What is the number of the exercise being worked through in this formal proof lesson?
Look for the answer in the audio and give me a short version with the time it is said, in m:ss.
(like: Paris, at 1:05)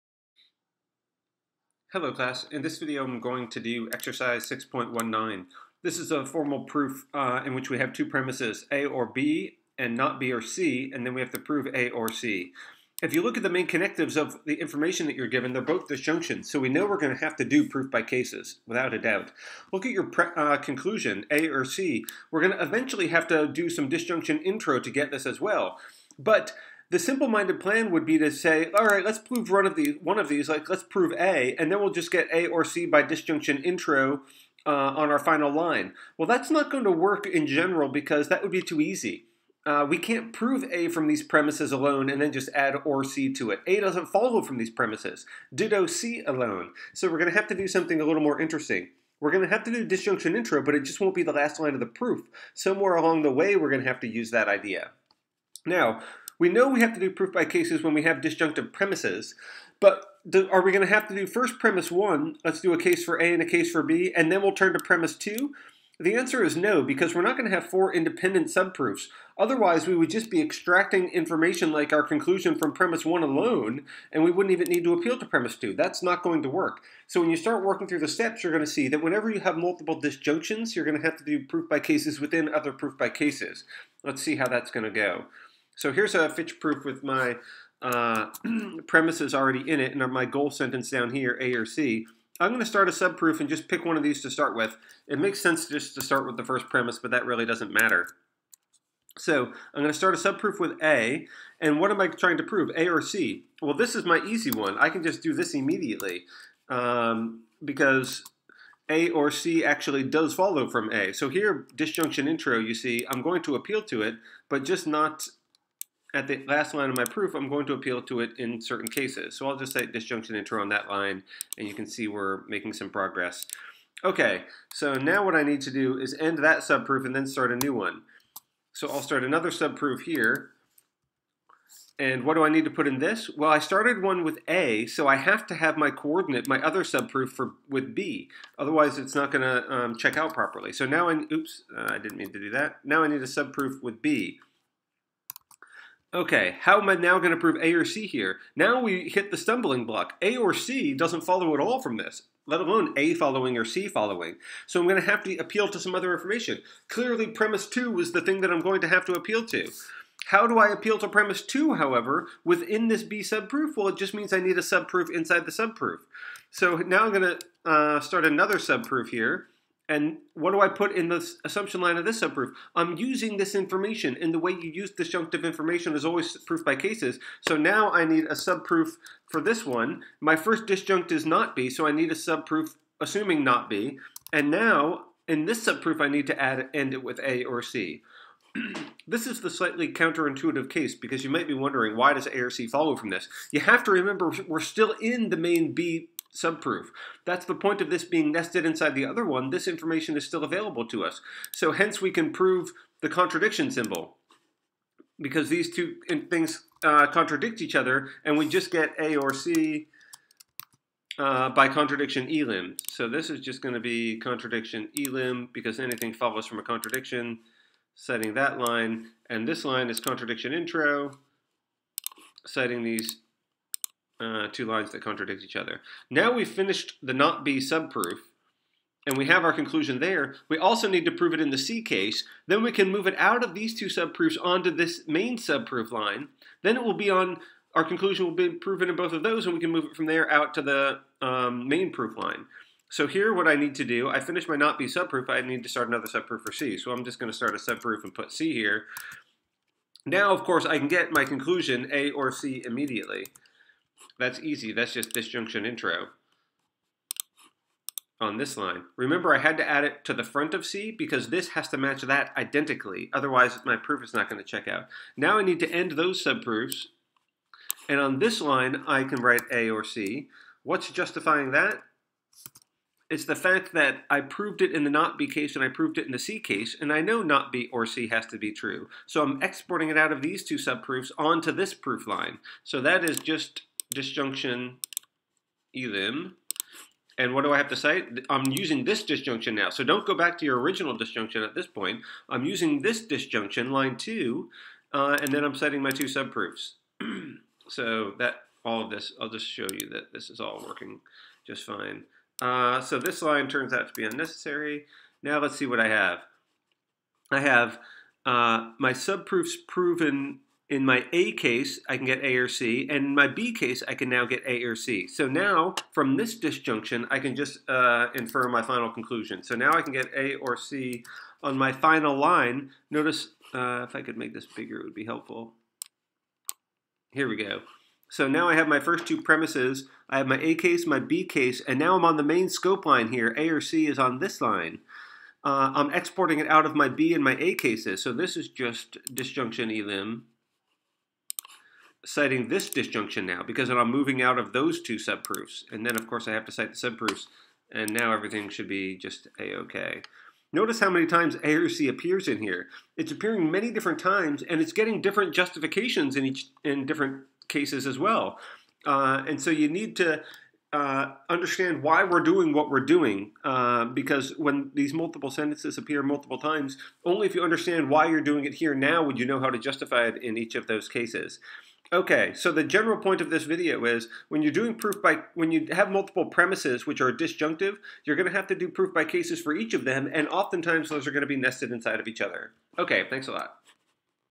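6.19, at 0:04.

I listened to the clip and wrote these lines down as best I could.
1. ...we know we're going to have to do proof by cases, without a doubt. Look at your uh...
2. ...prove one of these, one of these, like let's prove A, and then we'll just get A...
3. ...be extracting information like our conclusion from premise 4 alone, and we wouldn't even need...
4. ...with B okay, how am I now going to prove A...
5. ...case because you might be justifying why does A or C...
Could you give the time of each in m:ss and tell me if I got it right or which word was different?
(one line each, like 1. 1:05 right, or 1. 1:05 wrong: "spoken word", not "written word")
1. 0:16 right
2. 0:29 right
3. 1:10 wrong: "1", not "4"
4. 2:23 right
5. 3:10 wrong: "wondering", not "justifying".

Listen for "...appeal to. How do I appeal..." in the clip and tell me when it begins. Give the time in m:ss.
2:39.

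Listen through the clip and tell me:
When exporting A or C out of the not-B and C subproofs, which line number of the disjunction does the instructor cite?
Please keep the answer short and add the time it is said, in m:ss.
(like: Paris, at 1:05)
Line 2, at 4:53.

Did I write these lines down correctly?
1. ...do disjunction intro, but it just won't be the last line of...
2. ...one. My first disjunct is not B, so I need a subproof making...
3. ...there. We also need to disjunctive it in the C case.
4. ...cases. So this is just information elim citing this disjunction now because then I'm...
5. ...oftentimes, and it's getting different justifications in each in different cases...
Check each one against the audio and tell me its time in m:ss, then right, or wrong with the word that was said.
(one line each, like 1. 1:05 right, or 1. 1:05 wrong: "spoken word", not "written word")
1. 0:49 right
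2. 2:59 wrong: "assuming", not "making"
3. 3:49 wrong: "prove", not "disjunctive"
4. 5:37 wrong: "disjunction", not "information"
5. 5:53 wrong: "times", not "oftentimes".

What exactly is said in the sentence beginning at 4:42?
So that is just disjunction elim.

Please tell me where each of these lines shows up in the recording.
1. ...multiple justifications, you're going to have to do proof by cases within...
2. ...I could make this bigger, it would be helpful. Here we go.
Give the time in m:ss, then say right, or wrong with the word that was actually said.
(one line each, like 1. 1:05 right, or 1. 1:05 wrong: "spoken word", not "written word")
1. 1:19 wrong: "disjunctions", not "justifications"
2. 5:23 right.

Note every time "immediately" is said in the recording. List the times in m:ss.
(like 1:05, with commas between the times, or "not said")
1:45, 4:12.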